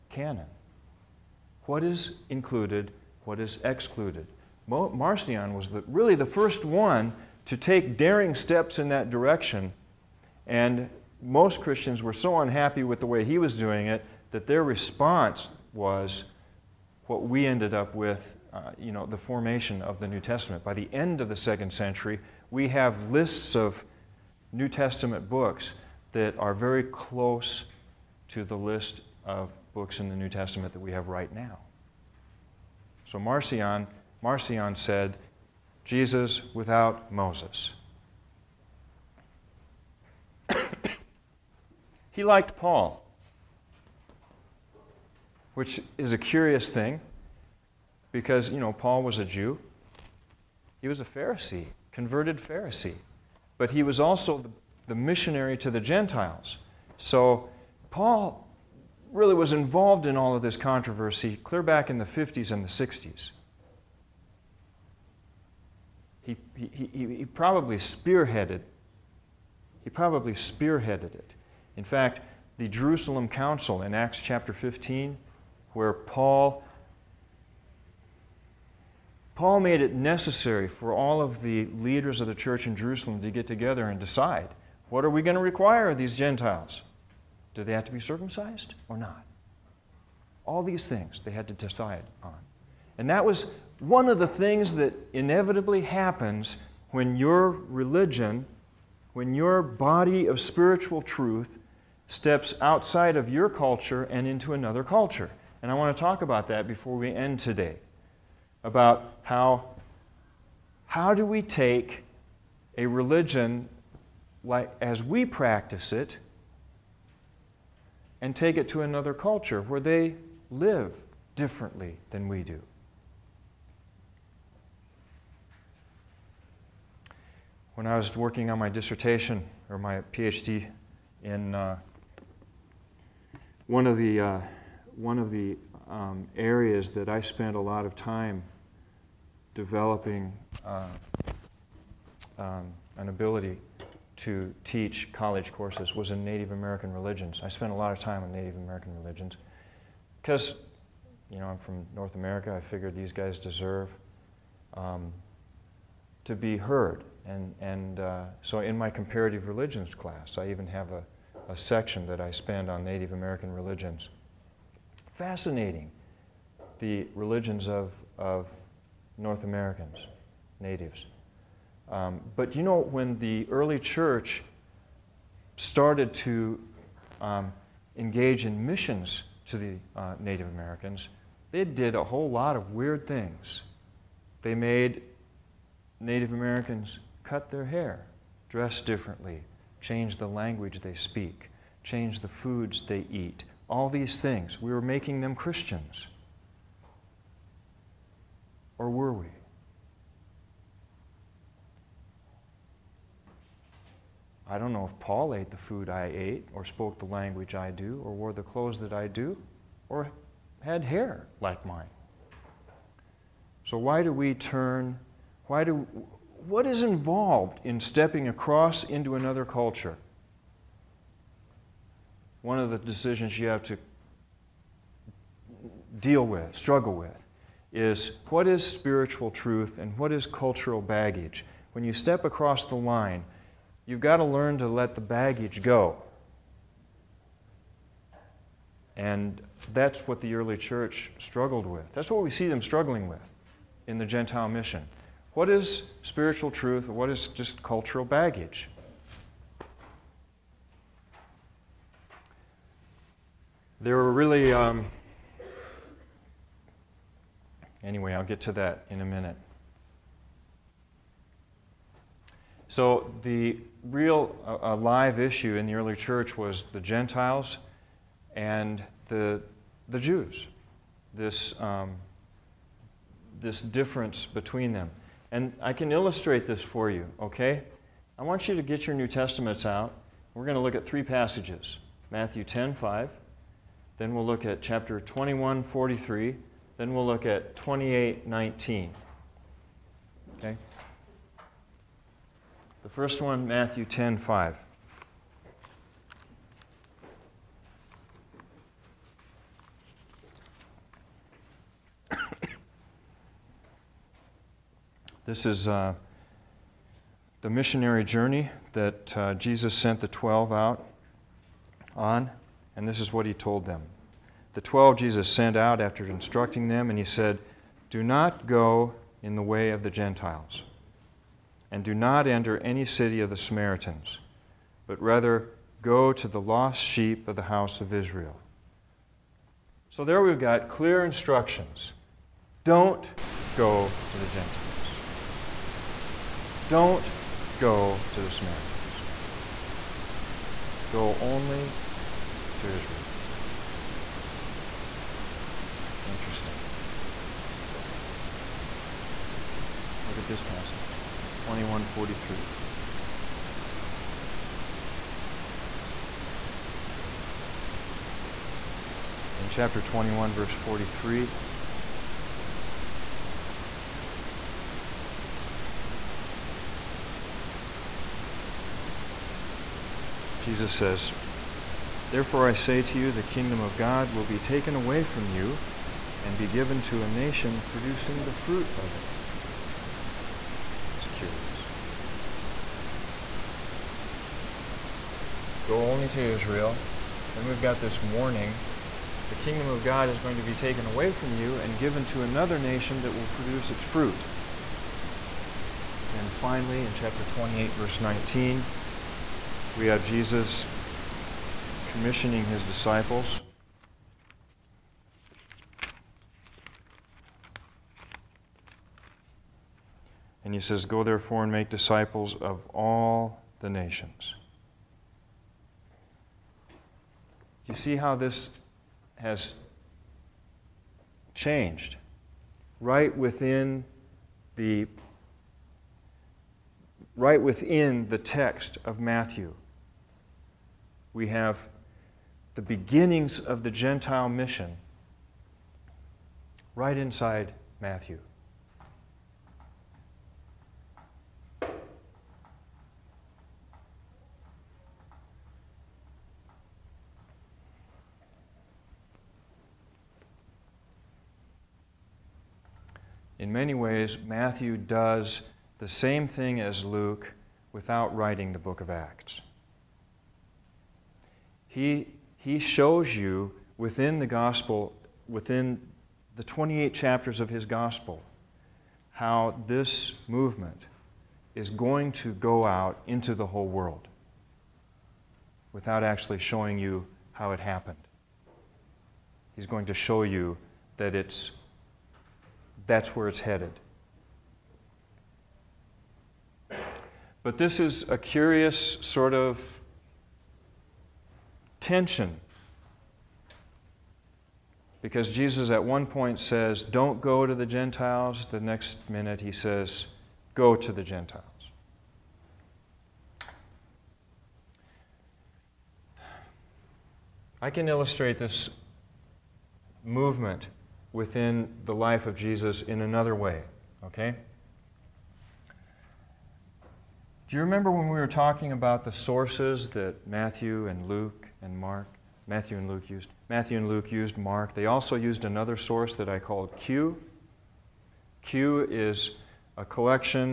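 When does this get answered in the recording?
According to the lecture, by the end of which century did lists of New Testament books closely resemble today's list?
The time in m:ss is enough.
0:21.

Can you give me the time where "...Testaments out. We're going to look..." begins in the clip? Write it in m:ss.
4:39.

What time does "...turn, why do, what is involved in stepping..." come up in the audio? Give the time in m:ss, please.
3:34.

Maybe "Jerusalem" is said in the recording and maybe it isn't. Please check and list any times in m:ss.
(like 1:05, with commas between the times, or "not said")
1:12, 1:22.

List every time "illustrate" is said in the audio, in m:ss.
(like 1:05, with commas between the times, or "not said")
4:35, 8:27.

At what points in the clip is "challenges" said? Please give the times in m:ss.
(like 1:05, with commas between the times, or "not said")
not said.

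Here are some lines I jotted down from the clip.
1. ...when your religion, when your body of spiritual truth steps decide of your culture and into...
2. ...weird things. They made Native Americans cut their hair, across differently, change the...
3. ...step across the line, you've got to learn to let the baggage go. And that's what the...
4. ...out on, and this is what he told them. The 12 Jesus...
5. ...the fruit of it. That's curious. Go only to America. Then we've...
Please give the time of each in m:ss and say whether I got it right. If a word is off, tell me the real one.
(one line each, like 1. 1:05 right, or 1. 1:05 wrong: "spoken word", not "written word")
1. 1:36 wrong: "outside", not "decide"
2. 3:02 wrong: "dress", not "across"
3. 3:51 right
4. 5:10 right
5. 6:18 wrong: "Israel", not "America".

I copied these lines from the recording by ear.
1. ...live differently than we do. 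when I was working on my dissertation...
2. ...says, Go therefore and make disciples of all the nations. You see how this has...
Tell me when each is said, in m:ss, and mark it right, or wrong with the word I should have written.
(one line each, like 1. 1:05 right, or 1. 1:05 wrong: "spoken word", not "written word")
1. 2:00 right
2. 6:50 right.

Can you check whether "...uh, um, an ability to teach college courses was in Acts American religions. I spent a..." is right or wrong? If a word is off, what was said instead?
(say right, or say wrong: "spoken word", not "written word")
wrong: "Native", not "Acts".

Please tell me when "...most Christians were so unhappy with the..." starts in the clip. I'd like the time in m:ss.
0:11.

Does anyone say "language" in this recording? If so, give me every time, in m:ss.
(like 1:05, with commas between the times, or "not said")
3:10, 3:27.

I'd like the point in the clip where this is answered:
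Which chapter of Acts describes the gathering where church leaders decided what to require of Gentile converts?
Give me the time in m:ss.
1:13.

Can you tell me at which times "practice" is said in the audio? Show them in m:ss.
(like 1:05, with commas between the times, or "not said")
1:55.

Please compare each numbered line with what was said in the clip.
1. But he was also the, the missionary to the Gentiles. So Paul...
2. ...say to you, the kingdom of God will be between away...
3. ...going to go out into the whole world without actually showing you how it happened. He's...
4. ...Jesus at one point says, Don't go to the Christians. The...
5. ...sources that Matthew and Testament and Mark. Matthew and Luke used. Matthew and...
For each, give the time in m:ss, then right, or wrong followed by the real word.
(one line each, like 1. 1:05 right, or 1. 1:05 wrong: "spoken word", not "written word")
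1. 0:53 right
2. 6:12 wrong: "taken", not "between"
3. 7:51 right
4. 8:15 wrong: "Gentiles", not "Christians"
5. 8:39 wrong: "Luke", not "Testament".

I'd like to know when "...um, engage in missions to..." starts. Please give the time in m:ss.
2:57.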